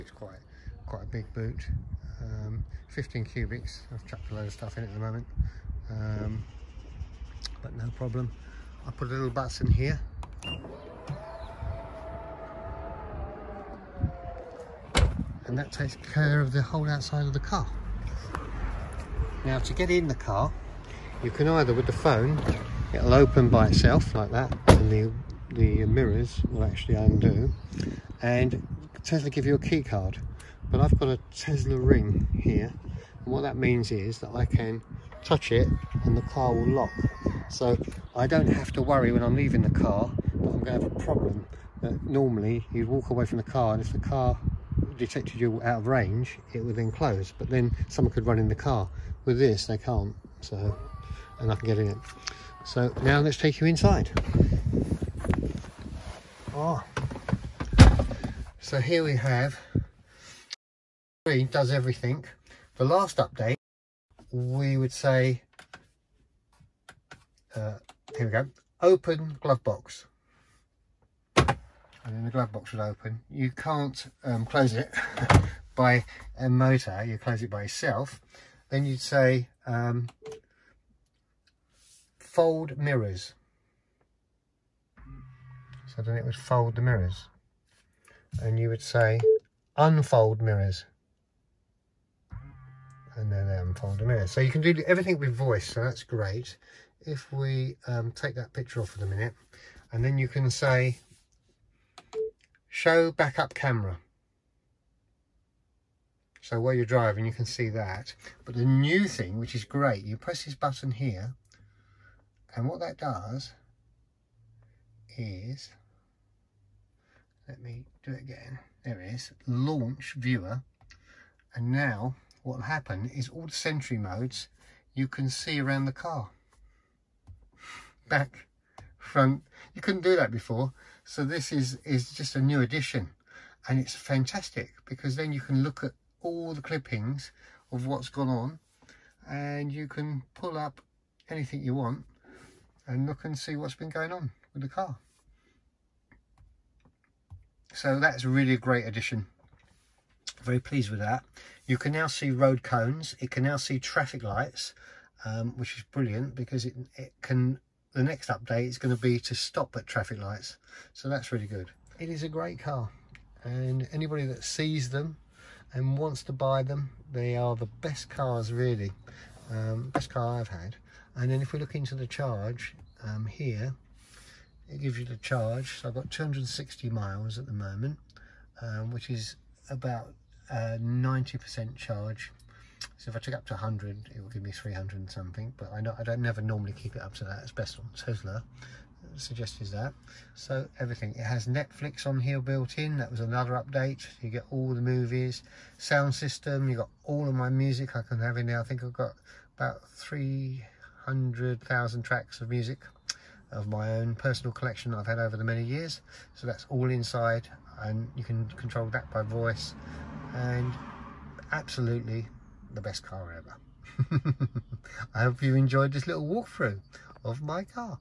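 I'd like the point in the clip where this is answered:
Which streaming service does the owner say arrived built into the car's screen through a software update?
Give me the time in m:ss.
3:11.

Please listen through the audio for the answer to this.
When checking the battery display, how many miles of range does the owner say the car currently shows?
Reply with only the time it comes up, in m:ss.
2:56.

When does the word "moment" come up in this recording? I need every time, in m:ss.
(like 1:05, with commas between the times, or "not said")
0:04, 2:57.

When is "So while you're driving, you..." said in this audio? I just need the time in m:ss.
1:46.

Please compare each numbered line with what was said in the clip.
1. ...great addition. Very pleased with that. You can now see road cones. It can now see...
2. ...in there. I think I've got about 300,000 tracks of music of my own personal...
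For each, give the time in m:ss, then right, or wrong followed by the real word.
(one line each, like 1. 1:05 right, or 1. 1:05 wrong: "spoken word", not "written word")
1. 2:28 right
2. 3:18 right.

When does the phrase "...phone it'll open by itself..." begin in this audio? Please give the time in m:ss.
0:21.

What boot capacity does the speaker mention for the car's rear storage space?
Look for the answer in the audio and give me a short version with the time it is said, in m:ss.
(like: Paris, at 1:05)
15 cubics, at 0:02.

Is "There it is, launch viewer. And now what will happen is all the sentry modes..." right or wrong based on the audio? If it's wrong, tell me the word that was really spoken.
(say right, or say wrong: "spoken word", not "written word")
right.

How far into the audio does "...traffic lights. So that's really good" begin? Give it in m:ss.
2:39.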